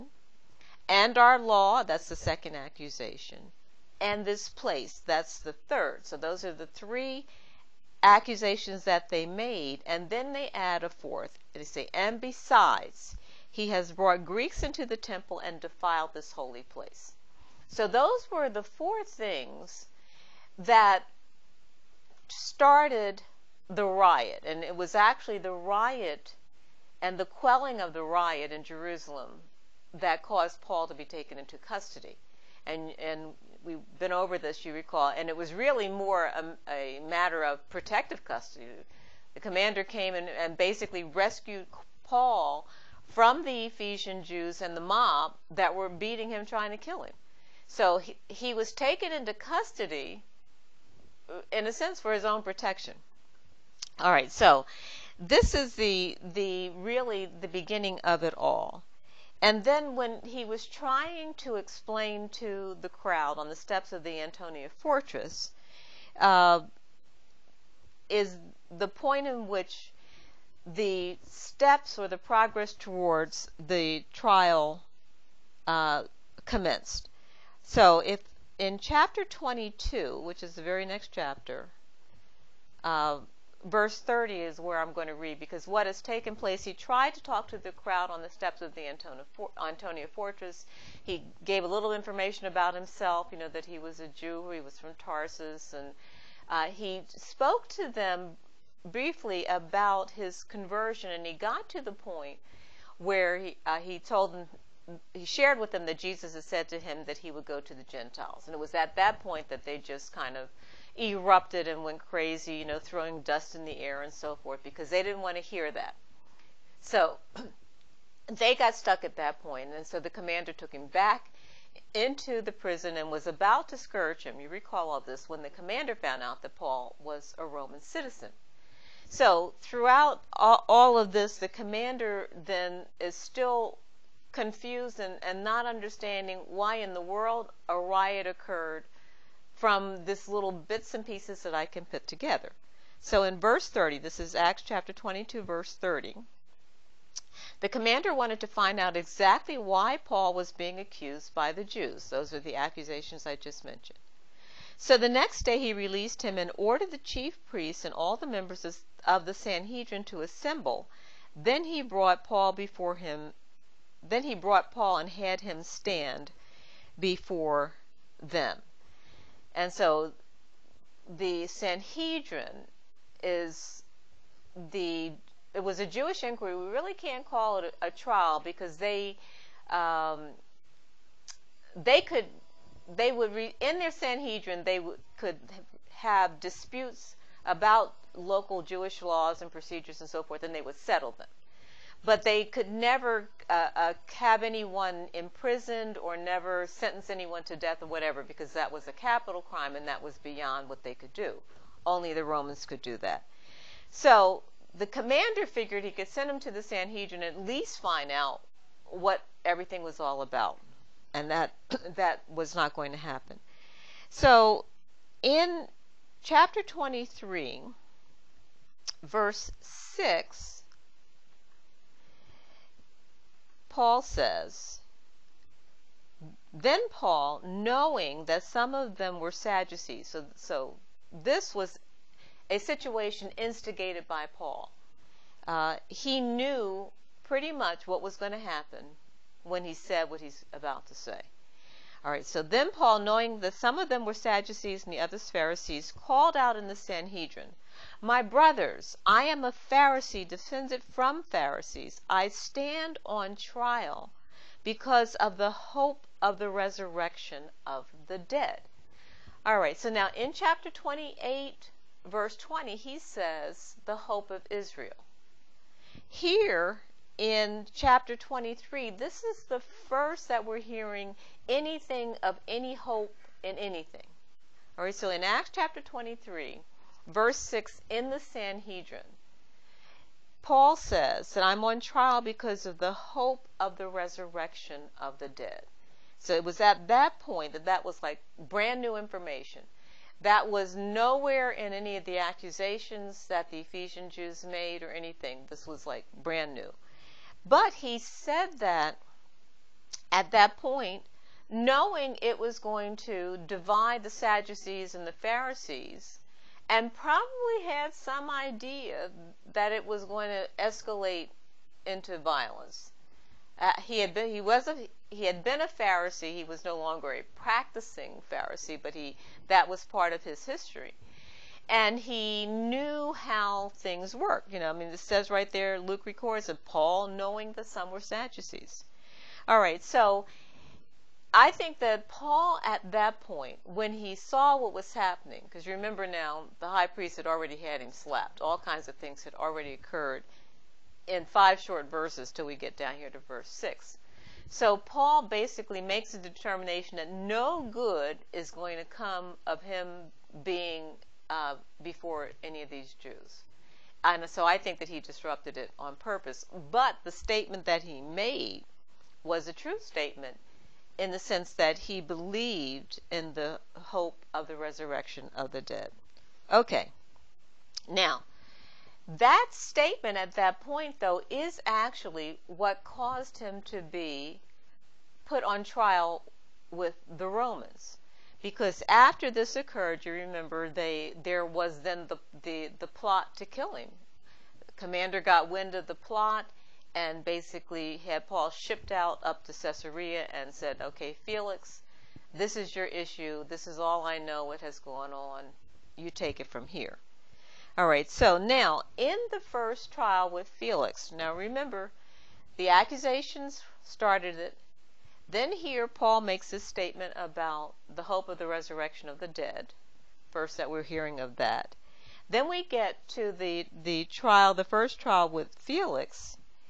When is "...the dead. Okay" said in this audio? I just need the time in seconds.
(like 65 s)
365 s.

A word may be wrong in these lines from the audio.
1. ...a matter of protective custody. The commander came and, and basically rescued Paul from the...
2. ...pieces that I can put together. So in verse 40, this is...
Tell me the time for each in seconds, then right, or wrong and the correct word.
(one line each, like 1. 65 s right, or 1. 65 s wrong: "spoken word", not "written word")
1. 36 s right
2. 141 s wrong: "30", not "40".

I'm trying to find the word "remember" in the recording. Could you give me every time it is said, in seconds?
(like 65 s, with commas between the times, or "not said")
335 s, 380 s, 401 s.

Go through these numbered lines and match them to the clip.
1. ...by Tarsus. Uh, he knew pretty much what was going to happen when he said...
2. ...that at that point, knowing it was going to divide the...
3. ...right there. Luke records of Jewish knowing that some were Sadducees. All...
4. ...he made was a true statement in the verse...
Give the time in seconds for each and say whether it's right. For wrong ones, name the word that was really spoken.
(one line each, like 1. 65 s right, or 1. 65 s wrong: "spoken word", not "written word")
1. 234 s wrong: "Paul", not "Tarsus"
2. 298 s right
3. 325 s wrong: "Paul", not "Jewish"
4. 357 s wrong: "sense", not "verse".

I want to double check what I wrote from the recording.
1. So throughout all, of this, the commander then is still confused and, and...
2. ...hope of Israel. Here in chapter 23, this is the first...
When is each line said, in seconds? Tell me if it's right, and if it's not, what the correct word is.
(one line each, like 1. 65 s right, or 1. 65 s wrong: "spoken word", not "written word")
1. 129 s right
2. 264 s right.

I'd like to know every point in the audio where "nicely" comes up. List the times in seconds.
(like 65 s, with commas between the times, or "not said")
not said.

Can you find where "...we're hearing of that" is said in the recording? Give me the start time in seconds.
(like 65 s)
410 s.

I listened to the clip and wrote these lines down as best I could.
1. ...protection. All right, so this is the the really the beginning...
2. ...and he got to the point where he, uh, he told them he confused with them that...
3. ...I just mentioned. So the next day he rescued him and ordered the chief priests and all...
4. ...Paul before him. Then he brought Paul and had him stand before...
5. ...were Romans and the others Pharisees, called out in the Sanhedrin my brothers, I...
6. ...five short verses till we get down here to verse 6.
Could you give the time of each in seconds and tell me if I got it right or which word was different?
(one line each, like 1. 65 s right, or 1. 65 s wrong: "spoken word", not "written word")
1. 52 s right
2. 101 s wrong: "shared", not "confused"
3. 153 s wrong: "released", not "rescued"
4. 162 s right
5. 244 s wrong: "Sadducees", not "Romans"
6. 341 s right.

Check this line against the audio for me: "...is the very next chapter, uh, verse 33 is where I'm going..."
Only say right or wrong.
wrong.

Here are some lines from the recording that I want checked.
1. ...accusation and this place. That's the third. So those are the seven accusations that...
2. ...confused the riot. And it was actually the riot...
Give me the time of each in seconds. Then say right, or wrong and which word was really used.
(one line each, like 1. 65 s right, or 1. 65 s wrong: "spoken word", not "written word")
1. 2 s wrong: "three", not "seven"
2. 22 s wrong: "started", not "confused".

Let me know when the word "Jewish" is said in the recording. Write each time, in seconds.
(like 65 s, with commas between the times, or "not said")
175 s, 188 s.